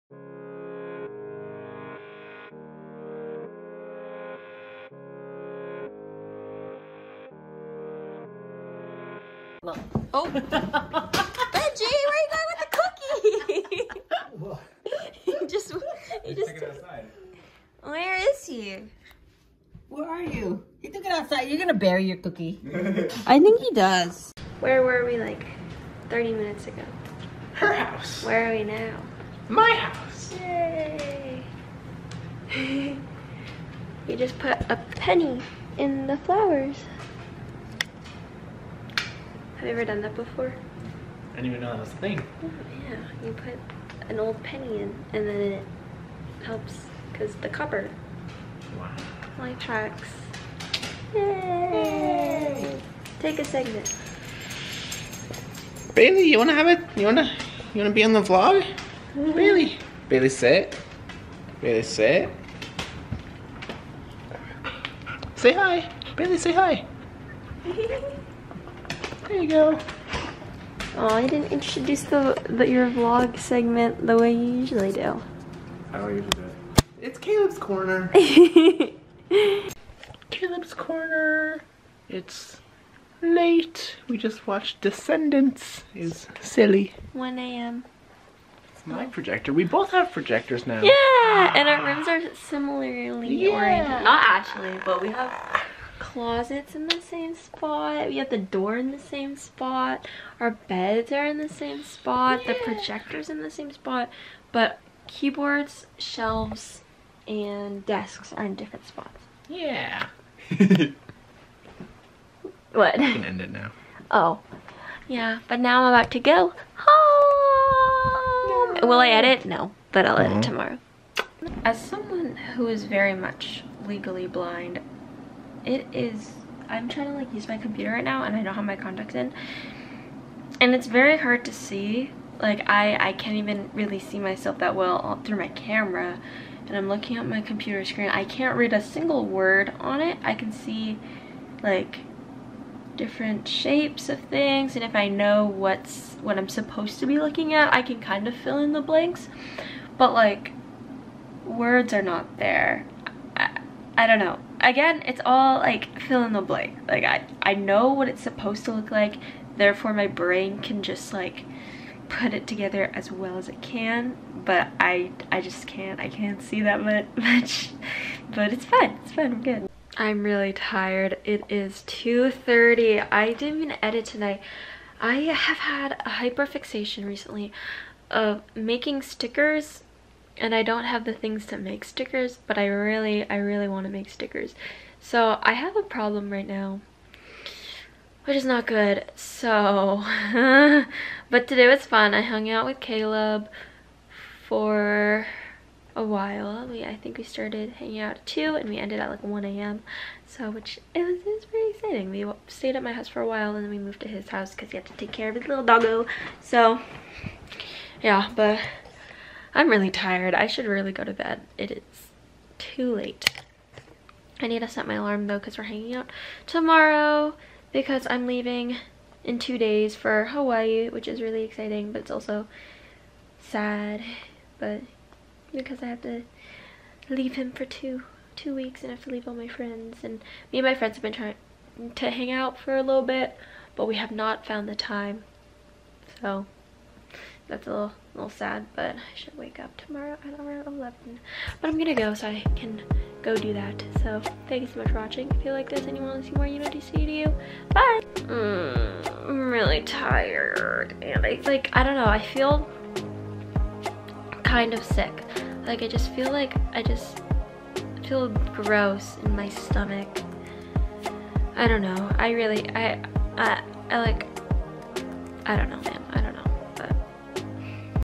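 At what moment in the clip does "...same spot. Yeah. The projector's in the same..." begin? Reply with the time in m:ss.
1:41.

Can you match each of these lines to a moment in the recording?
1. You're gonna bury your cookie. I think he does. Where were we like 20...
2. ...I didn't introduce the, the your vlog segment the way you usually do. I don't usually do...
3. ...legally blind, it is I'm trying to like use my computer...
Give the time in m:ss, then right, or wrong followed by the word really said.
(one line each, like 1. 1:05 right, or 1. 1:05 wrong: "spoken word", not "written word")
1. 0:21 wrong: "30", not "20"
2. 1:11 right
3. 2:03 right.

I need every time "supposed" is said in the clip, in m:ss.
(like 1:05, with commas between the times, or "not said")
2:26, 2:38.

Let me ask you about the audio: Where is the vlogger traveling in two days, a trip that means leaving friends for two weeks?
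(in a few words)
Hawaii.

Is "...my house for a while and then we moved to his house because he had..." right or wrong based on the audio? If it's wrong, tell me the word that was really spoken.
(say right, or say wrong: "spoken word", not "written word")
right.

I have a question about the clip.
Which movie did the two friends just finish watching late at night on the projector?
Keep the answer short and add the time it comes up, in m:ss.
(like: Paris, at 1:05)
Descendants, at 1:24.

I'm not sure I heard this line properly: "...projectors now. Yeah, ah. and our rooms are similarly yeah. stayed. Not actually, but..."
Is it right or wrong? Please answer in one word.
wrong.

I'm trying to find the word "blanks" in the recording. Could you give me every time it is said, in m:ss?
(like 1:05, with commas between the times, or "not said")
2:28, 2:36.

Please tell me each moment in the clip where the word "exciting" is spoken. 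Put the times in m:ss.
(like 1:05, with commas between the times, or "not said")
3:21, 3:41.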